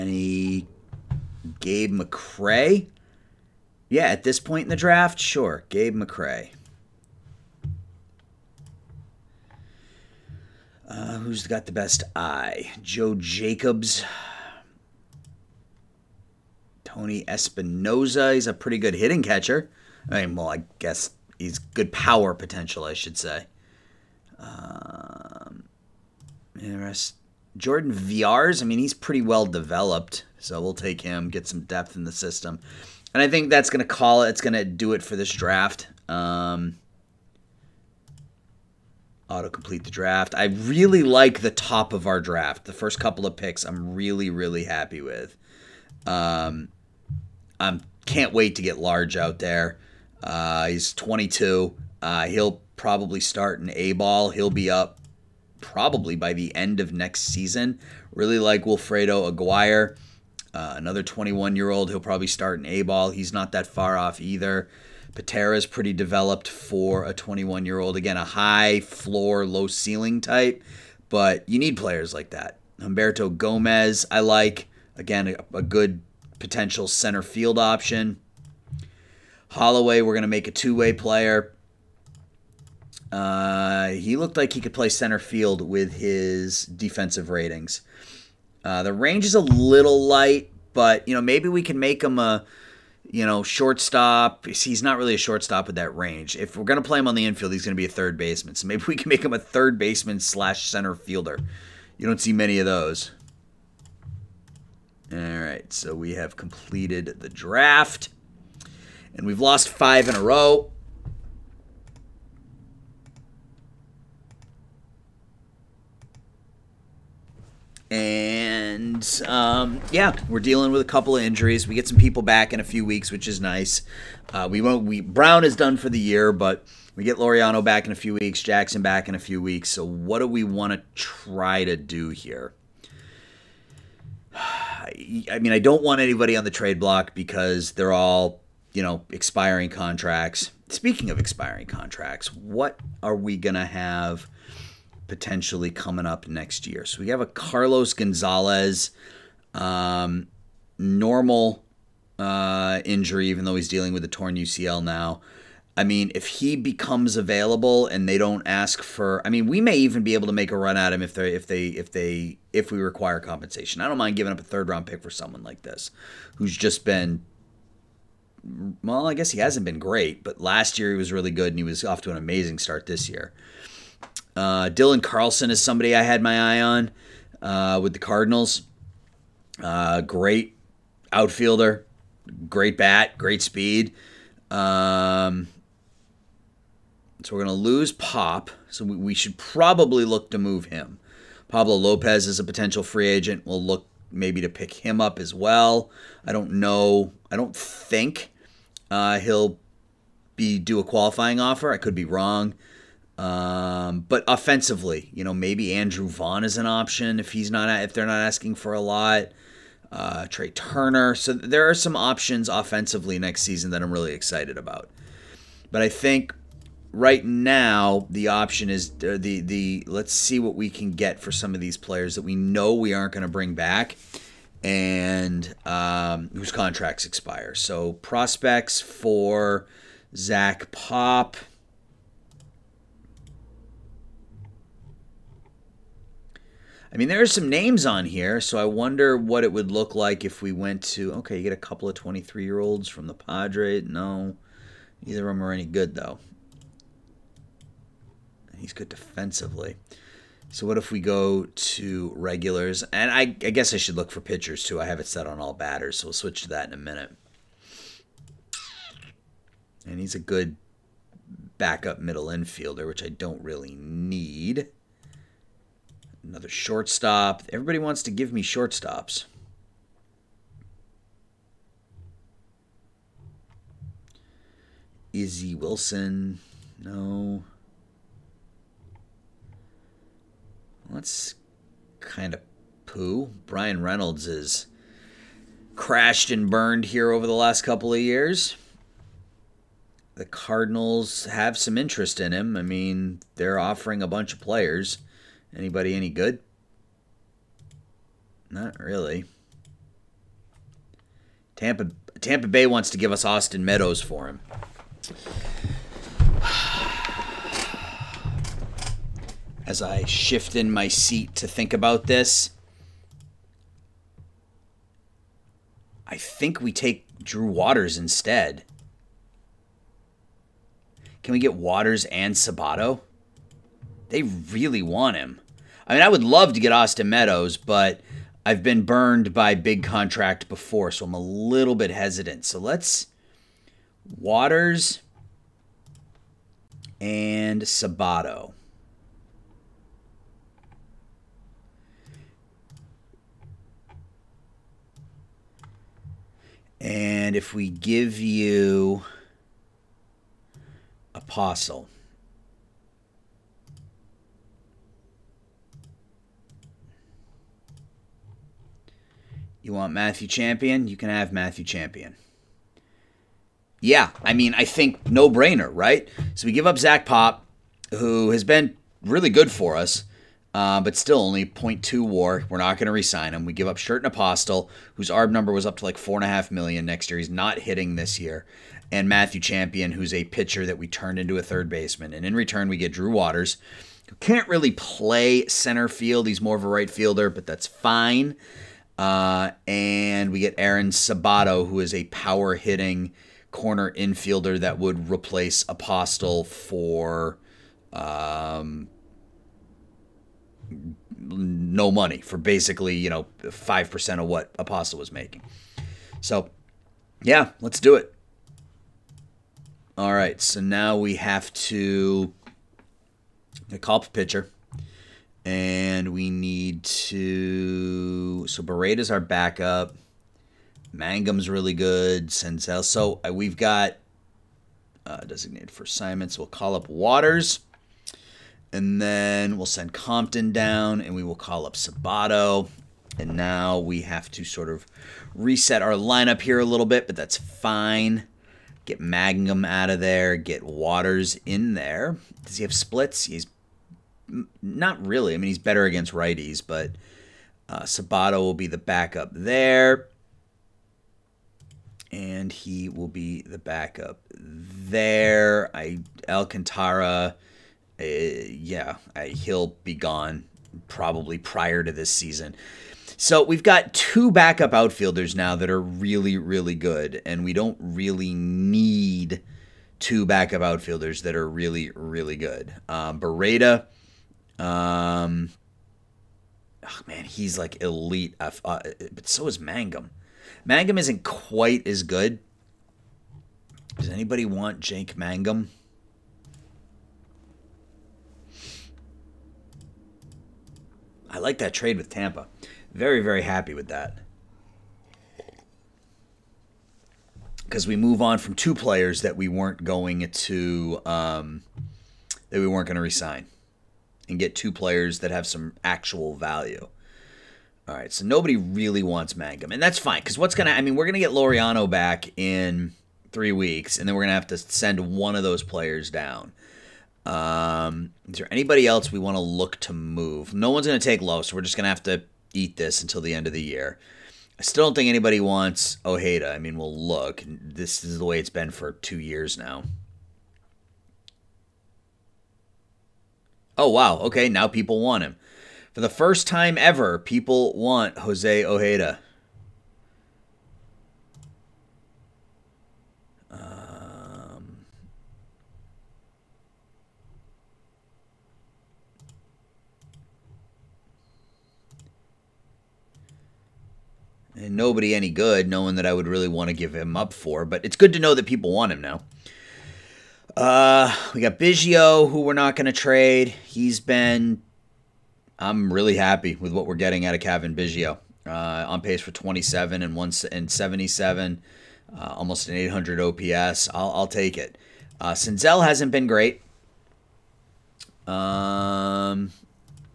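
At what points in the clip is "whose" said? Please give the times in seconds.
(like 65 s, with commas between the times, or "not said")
226 s, 374 s.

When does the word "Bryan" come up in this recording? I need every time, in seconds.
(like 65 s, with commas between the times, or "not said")
283 s.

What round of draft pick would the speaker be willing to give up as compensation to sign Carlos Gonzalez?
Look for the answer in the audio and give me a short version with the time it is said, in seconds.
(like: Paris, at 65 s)
third round, at 164 s.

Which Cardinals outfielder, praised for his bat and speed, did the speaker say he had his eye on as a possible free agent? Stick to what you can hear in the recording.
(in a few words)
Dylan Carlson.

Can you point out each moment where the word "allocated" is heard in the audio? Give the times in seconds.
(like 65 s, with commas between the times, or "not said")
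not said.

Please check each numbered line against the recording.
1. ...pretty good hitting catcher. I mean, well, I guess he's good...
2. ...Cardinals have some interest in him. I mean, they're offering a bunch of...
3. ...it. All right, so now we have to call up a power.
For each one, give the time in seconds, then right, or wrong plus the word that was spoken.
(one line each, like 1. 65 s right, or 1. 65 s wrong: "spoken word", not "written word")
1. 18 s right
2. 290 s right
3. 407 s wrong: "pitcher", not "power".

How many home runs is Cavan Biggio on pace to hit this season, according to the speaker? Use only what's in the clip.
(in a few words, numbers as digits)
27.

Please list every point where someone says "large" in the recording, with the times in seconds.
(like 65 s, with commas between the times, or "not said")
48 s.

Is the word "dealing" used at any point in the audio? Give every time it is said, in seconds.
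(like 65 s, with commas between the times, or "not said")
120 s, 153 s.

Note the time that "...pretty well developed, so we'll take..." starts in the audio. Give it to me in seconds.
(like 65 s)
28 s.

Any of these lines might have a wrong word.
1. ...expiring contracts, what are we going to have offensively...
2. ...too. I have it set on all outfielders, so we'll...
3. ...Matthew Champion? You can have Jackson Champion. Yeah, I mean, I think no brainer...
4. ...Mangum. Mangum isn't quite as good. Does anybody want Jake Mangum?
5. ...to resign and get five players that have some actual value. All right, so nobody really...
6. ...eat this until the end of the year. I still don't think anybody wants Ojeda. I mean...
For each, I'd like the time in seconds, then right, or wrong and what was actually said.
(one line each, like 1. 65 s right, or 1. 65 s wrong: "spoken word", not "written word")
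1. 141 s wrong: "potentially", not "offensively"
2. 254 s wrong: "batters", not "outfielders"
3. 359 s wrong: "Matthew", not "Jackson"
4. 479 s right
5. 502 s wrong: "two", not "five"
6. 522 s right.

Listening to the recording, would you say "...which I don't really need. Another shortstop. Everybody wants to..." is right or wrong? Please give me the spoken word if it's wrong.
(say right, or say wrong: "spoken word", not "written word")
right.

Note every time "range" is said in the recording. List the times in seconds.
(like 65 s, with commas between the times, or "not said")
88 s, 95 s.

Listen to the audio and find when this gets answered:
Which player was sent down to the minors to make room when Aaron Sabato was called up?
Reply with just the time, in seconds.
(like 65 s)
429 s.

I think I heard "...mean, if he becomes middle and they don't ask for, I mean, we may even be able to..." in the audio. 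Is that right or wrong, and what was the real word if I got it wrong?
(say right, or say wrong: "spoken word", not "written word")
wrong: "available", not "middle".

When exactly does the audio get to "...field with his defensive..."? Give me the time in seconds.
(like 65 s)
85 s.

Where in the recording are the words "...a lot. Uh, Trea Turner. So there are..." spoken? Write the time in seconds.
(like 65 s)
208 s.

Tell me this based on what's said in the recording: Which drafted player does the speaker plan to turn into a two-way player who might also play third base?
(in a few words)
Holloway.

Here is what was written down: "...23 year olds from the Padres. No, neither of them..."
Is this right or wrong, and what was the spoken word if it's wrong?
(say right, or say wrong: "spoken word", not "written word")
right.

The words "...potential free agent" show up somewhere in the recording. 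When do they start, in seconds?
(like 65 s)
192 s.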